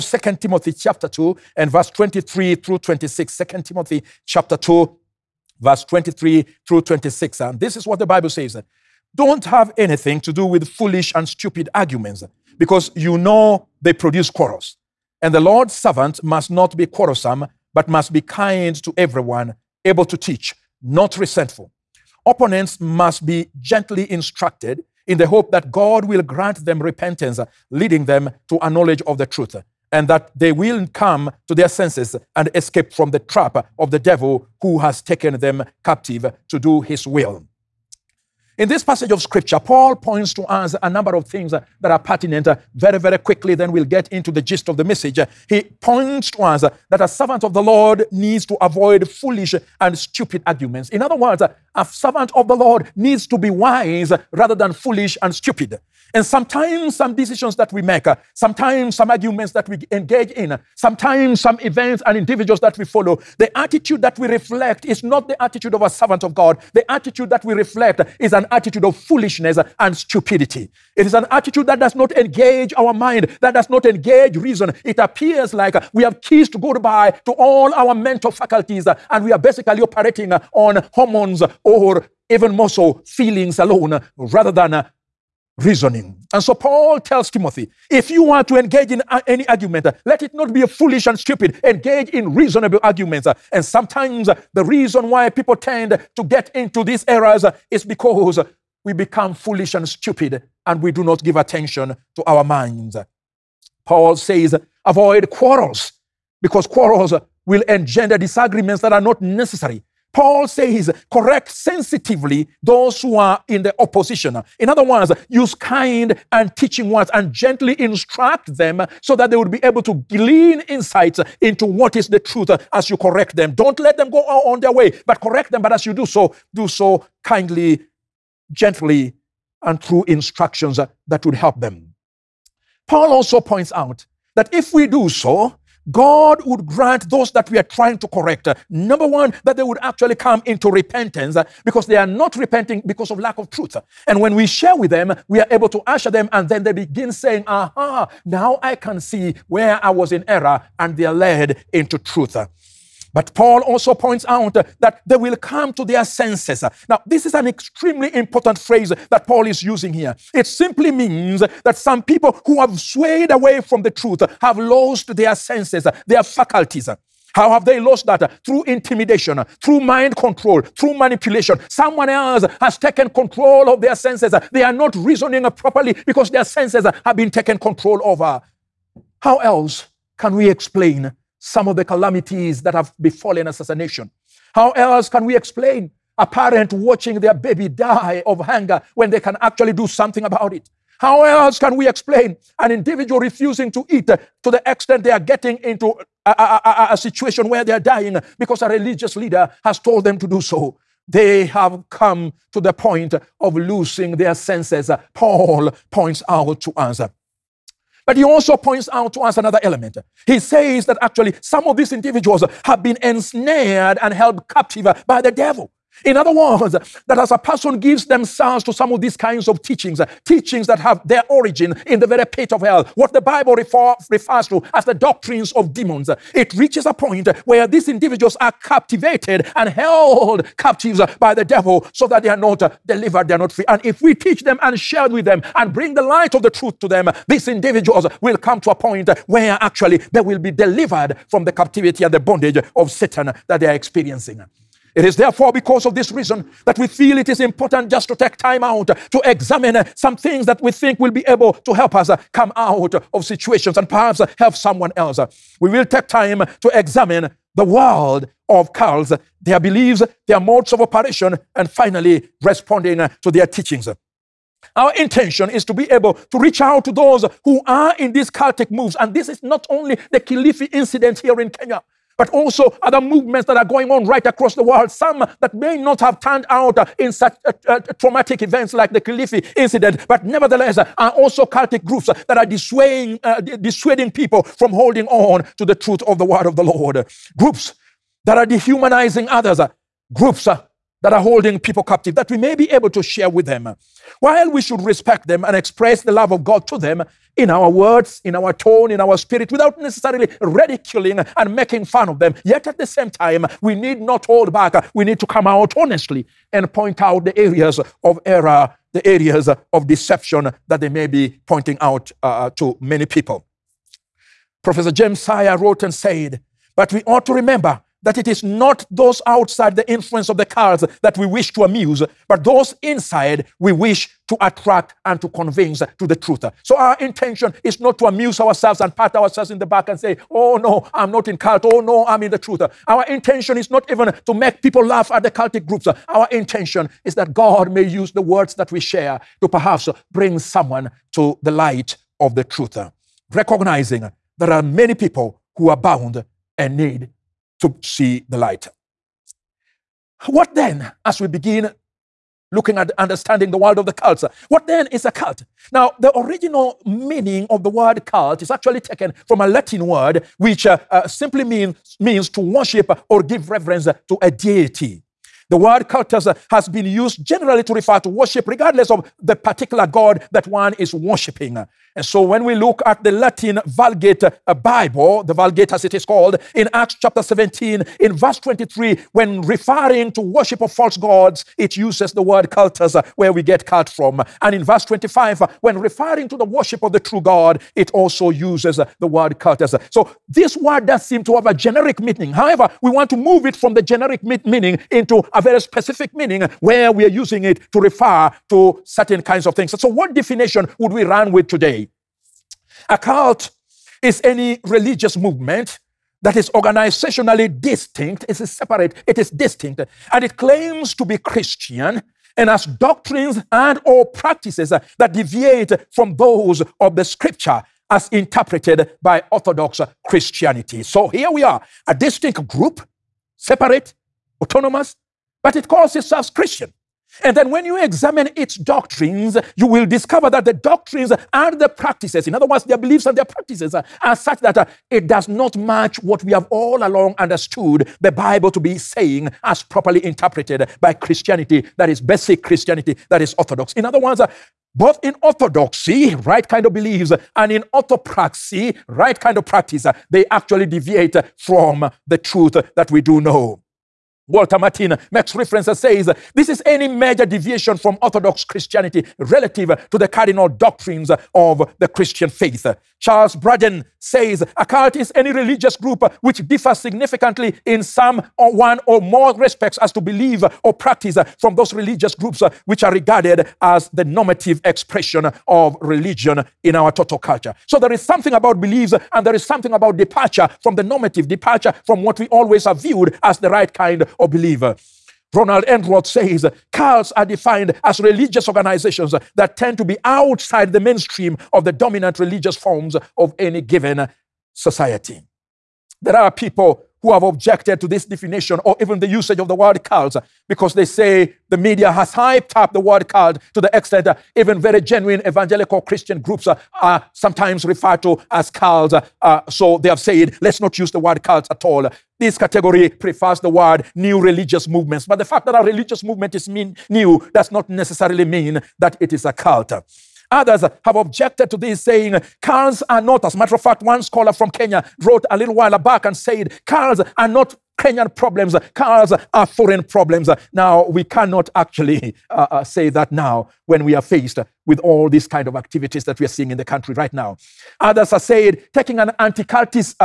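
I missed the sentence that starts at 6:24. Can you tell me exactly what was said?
And in verse 25, uh, when referring to the worship of the true God, it also uses the word cultus.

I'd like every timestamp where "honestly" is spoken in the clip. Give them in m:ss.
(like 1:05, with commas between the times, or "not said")
5:05.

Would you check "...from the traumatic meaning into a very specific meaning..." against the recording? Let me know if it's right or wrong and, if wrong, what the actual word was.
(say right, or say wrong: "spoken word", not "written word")
wrong: "generic", not "traumatic".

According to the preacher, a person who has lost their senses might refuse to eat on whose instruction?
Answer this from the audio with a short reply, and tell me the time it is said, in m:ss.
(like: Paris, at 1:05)
A religious leader, at 3:18.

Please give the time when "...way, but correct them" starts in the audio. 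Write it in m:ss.
2:04.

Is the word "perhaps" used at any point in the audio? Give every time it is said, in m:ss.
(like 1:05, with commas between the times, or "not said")
4:13, 5:39.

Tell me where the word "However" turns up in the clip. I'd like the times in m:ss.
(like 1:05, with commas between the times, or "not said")
6:32.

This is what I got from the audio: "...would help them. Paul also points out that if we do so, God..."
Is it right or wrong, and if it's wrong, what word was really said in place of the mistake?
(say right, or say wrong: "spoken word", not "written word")
right.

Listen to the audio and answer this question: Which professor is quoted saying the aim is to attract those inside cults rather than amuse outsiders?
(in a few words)
James Sire.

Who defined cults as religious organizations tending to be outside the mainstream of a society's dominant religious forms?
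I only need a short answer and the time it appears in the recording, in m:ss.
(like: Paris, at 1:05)
Ronald Enroth, at 8:05.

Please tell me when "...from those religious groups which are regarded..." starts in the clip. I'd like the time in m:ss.
7:51.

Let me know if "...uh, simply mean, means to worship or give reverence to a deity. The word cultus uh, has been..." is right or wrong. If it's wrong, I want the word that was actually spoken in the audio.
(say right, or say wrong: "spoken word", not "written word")
right.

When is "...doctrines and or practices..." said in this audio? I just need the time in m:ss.
6:52.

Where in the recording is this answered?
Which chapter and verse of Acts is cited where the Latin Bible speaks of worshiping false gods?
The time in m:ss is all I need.
6:16.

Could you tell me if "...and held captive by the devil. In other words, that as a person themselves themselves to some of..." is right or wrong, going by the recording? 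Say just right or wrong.
wrong.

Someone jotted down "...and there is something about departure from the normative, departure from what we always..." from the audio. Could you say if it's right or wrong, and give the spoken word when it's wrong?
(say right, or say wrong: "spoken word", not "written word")
right.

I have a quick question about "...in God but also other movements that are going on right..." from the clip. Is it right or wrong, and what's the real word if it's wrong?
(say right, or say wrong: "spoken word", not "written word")
wrong: "Kenya", not "God".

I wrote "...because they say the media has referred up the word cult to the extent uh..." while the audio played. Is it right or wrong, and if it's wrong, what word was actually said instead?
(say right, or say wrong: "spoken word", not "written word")
wrong: "hyped", not "referred".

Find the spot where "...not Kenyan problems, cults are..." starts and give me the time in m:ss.
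8:47.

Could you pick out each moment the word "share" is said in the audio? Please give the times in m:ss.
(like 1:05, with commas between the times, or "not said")
2:24, 3:54, 4:53, 5:38.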